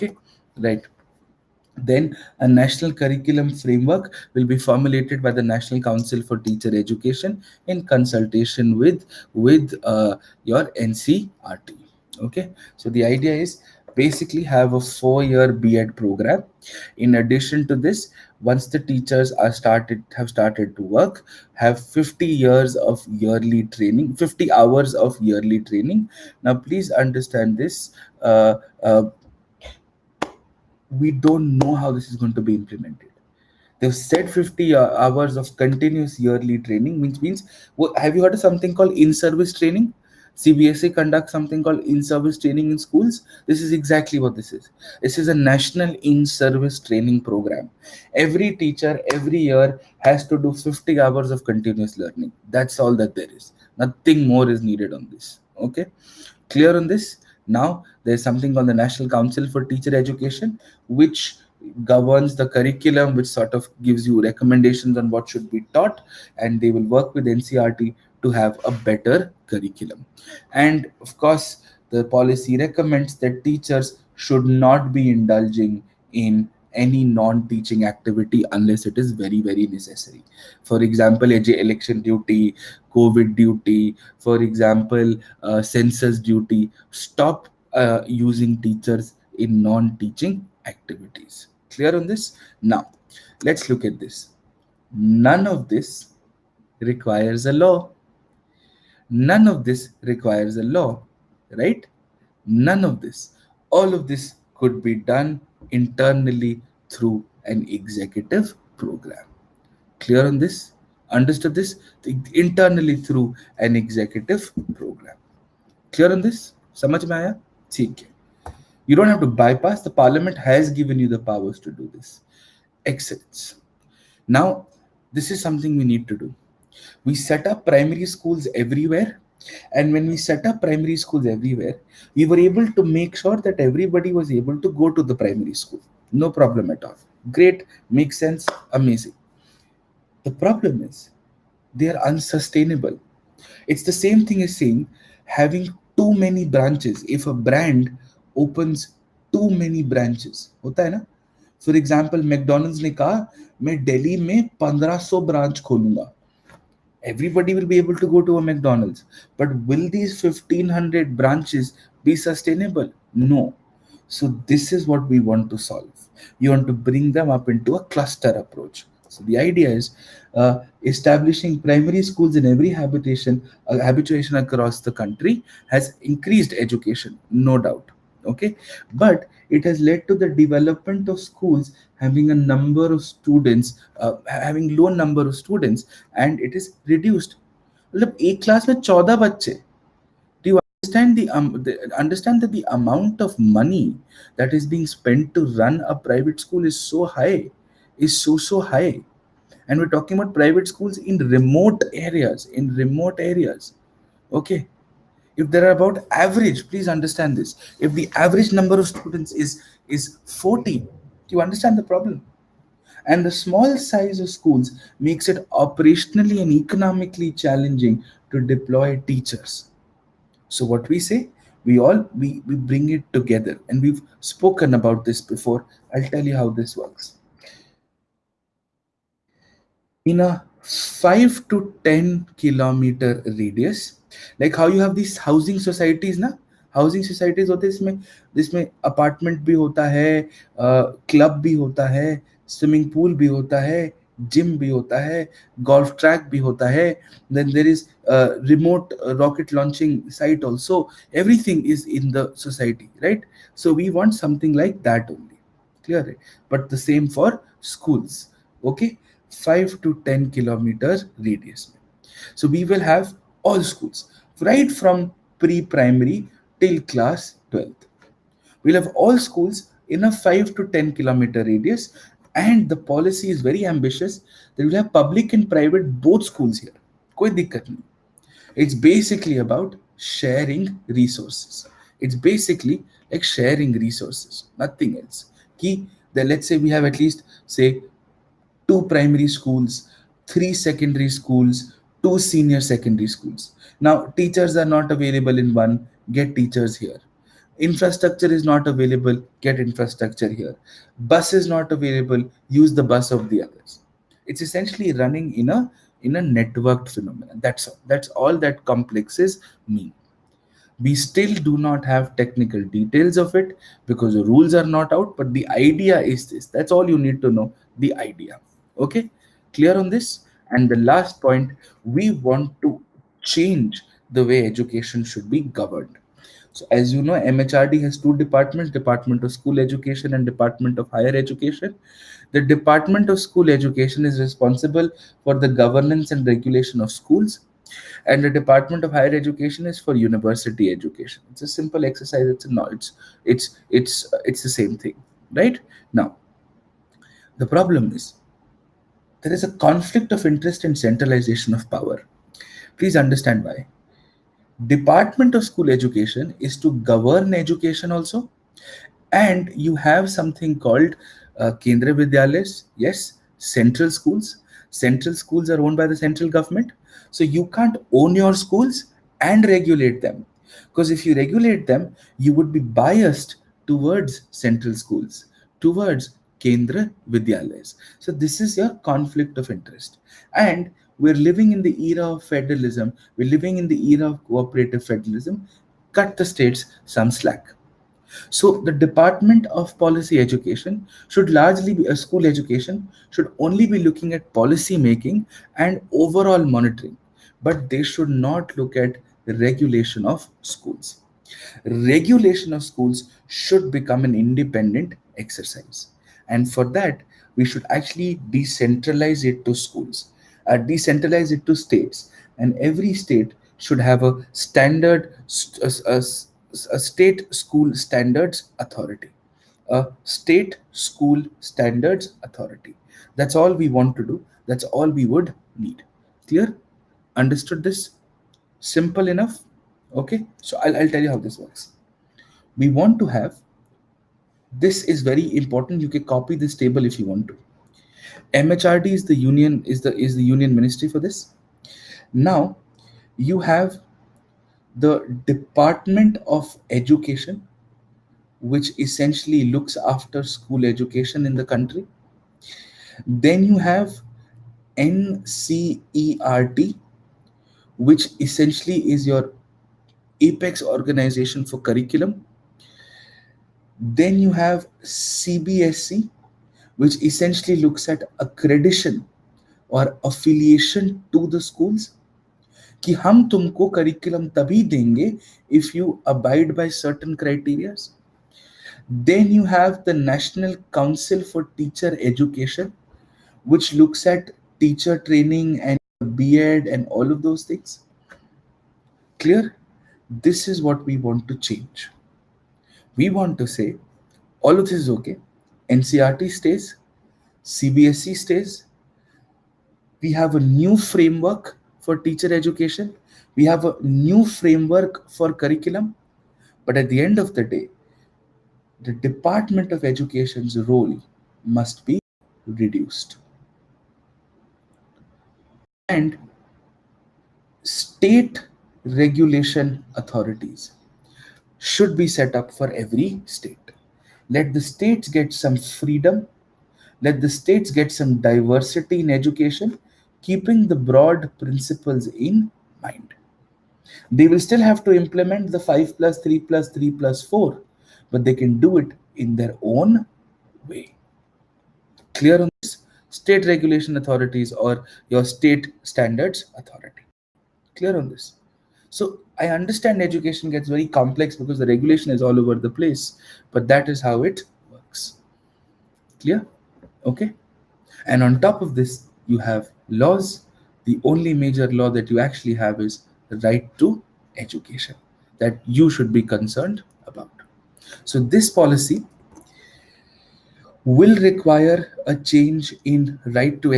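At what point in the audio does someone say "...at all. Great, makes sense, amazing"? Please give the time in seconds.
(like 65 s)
136 s.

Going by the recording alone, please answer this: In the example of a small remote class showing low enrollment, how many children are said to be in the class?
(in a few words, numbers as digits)
14.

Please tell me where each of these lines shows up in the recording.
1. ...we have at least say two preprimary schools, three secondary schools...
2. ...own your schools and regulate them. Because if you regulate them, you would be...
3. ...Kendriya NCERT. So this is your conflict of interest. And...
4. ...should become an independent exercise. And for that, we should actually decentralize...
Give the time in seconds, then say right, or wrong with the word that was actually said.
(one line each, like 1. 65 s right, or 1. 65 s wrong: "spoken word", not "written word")
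1. 286 s wrong: "primary", not "preprimary"
2. 367 s right
3. 376 s wrong: "Vidyalayas", not "NCERT"
4. 403 s right.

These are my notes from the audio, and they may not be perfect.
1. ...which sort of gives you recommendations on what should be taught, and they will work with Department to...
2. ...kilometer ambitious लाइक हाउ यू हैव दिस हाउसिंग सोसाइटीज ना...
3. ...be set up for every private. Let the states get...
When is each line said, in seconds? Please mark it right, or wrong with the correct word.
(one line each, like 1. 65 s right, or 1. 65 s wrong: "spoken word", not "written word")
1. 63 s wrong: "NCERT", not "Department"
2. 232 s wrong: "radius", not "ambitious"
3. 521 s wrong: "state", not "private".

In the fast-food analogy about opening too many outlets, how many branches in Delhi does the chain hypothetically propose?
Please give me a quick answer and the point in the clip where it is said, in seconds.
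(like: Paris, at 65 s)
1500, at 154 s.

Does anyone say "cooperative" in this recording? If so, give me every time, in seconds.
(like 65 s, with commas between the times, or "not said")
384 s.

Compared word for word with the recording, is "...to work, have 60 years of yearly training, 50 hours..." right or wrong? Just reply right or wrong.
wrong.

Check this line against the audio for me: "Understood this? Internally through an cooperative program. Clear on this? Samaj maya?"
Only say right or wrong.
wrong.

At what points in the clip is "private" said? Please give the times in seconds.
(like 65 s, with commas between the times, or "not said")
196 s, 200 s, 275 s.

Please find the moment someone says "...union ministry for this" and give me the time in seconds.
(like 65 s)
440 s.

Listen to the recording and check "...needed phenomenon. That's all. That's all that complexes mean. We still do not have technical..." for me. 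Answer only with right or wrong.
wrong.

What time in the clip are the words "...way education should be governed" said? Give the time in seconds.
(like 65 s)
324 s.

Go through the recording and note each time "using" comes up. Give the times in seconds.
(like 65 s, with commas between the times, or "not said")
88 s.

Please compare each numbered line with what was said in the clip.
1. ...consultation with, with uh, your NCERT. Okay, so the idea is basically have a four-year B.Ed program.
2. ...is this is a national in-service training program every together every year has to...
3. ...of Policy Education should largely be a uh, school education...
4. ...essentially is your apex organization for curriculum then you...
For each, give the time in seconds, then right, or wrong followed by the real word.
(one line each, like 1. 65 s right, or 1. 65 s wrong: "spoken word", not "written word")
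1. 7 s right
2. 44 s wrong: "teacher", not "together"
3. 389 s right
4. 458 s right.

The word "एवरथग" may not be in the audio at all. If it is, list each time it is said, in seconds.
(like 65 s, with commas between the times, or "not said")
251 s.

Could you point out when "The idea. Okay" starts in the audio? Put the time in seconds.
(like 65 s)
317 s.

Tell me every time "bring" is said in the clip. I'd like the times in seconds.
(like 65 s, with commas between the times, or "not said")
166 s, 222 s.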